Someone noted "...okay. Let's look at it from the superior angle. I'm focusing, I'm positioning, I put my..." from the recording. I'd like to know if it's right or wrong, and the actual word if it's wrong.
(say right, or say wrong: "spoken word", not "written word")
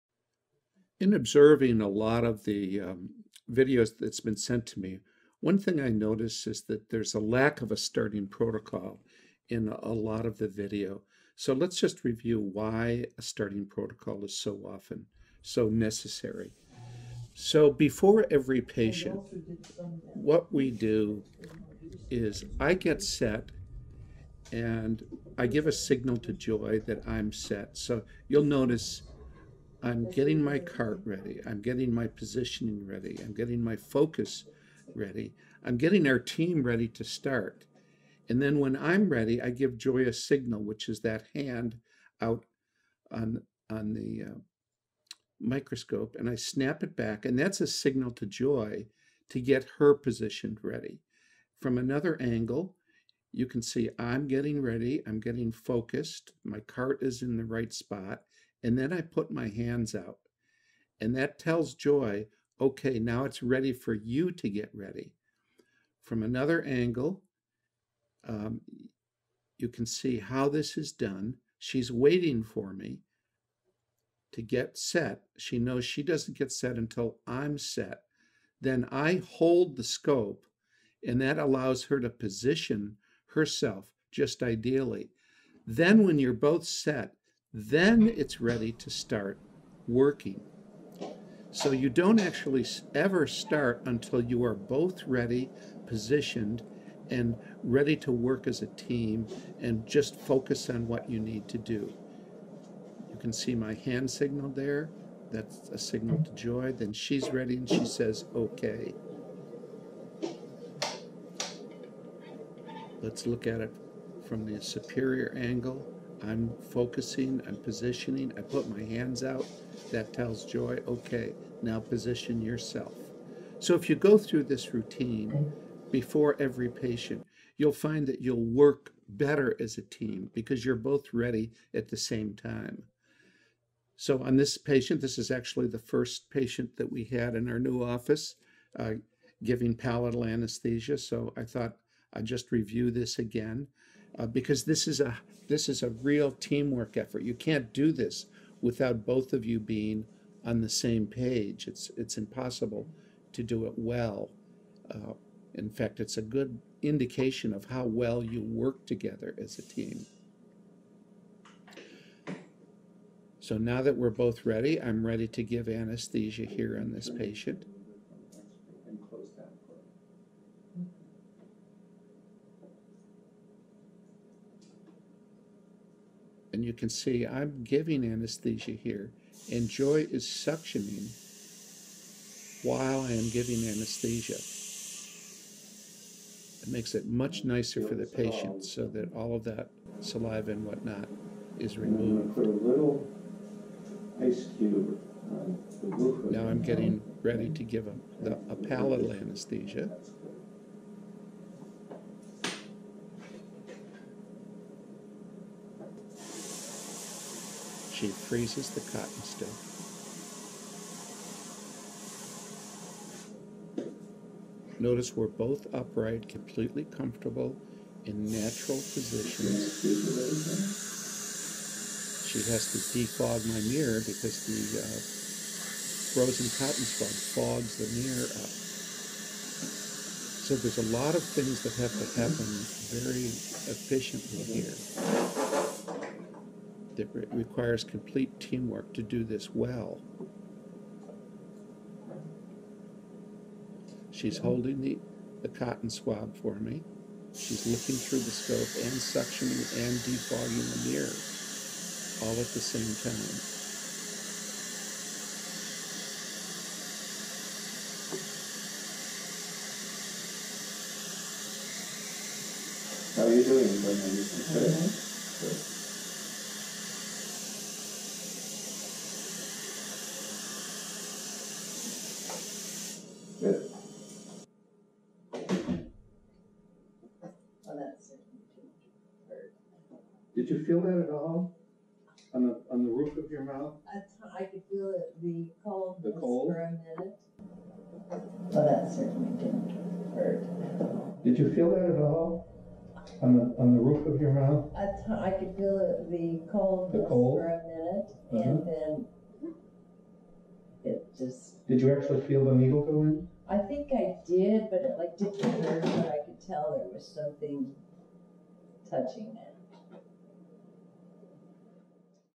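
right.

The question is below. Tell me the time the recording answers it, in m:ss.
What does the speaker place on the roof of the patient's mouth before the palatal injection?
3:14.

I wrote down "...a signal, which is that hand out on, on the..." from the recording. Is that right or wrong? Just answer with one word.
right.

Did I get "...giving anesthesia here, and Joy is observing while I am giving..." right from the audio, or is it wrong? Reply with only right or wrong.
wrong.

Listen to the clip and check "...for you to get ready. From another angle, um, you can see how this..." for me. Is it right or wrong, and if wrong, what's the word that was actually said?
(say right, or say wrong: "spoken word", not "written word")
right.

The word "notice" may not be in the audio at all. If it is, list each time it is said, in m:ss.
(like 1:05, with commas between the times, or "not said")
0:05, 0:28, 3:34.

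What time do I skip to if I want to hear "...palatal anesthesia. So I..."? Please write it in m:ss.
2:19.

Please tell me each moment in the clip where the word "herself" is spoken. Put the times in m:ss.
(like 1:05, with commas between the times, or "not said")
1:23.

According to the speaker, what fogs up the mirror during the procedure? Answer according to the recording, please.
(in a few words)
Frozen cotton swab.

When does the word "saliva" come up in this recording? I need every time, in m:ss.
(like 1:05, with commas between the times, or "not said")
3:10.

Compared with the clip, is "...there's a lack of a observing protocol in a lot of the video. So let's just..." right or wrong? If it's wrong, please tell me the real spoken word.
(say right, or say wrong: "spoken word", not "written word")
wrong: "starting", not "observing".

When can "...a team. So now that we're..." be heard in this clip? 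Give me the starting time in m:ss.
2:39.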